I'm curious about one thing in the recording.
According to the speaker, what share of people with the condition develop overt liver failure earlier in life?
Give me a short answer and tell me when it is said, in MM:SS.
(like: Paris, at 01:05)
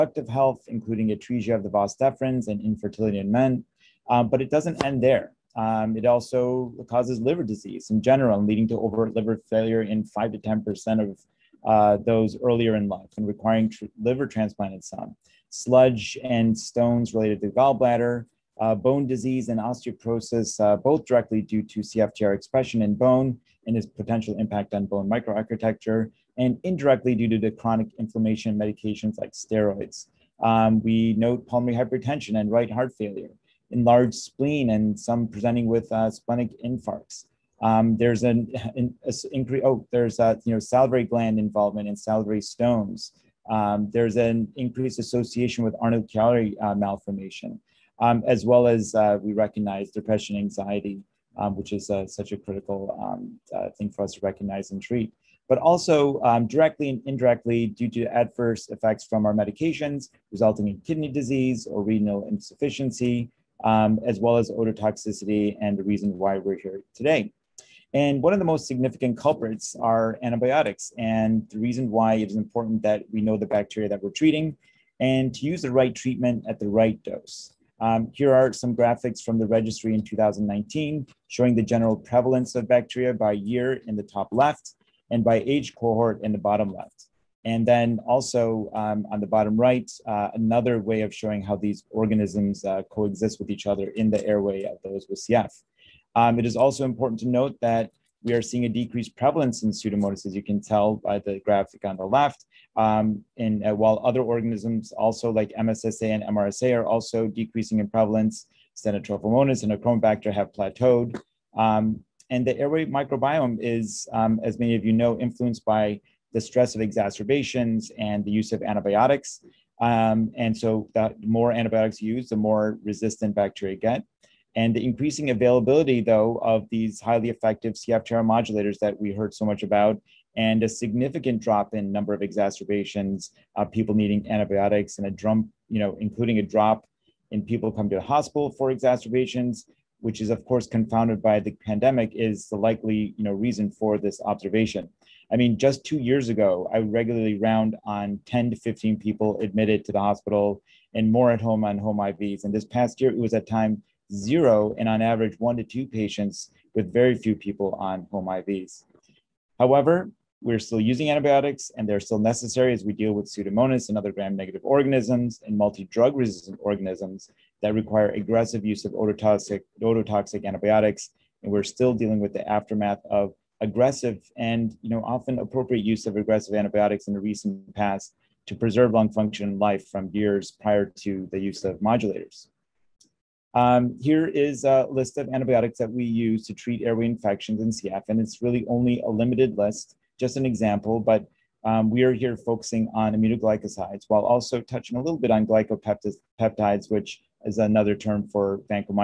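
5 to 10%, at 00:10.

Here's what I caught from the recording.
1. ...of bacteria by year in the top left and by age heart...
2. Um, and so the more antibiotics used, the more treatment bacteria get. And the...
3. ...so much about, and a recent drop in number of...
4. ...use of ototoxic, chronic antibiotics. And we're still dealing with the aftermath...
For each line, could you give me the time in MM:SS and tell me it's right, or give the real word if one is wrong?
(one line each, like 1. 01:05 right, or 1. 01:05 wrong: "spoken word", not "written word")
1. 01:22 wrong: "cohort", not "heart"
2. 01:59 wrong: "resistant", not "treatment"
3. 02:09 wrong: "significant", not "recent"
4. 02:48 wrong: "ototoxic", not "chronic".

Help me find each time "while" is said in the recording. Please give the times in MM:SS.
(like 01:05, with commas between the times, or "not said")
01:43, 03:14.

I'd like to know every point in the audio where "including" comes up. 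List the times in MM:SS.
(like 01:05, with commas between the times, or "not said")
00:00, 02:16.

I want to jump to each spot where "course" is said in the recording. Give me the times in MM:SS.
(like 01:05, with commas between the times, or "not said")
02:20.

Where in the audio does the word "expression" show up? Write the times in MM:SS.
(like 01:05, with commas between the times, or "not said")
00:22.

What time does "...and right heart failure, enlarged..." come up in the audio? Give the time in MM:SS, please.
00:32.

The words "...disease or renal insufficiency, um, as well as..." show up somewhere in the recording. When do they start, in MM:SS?
01:01.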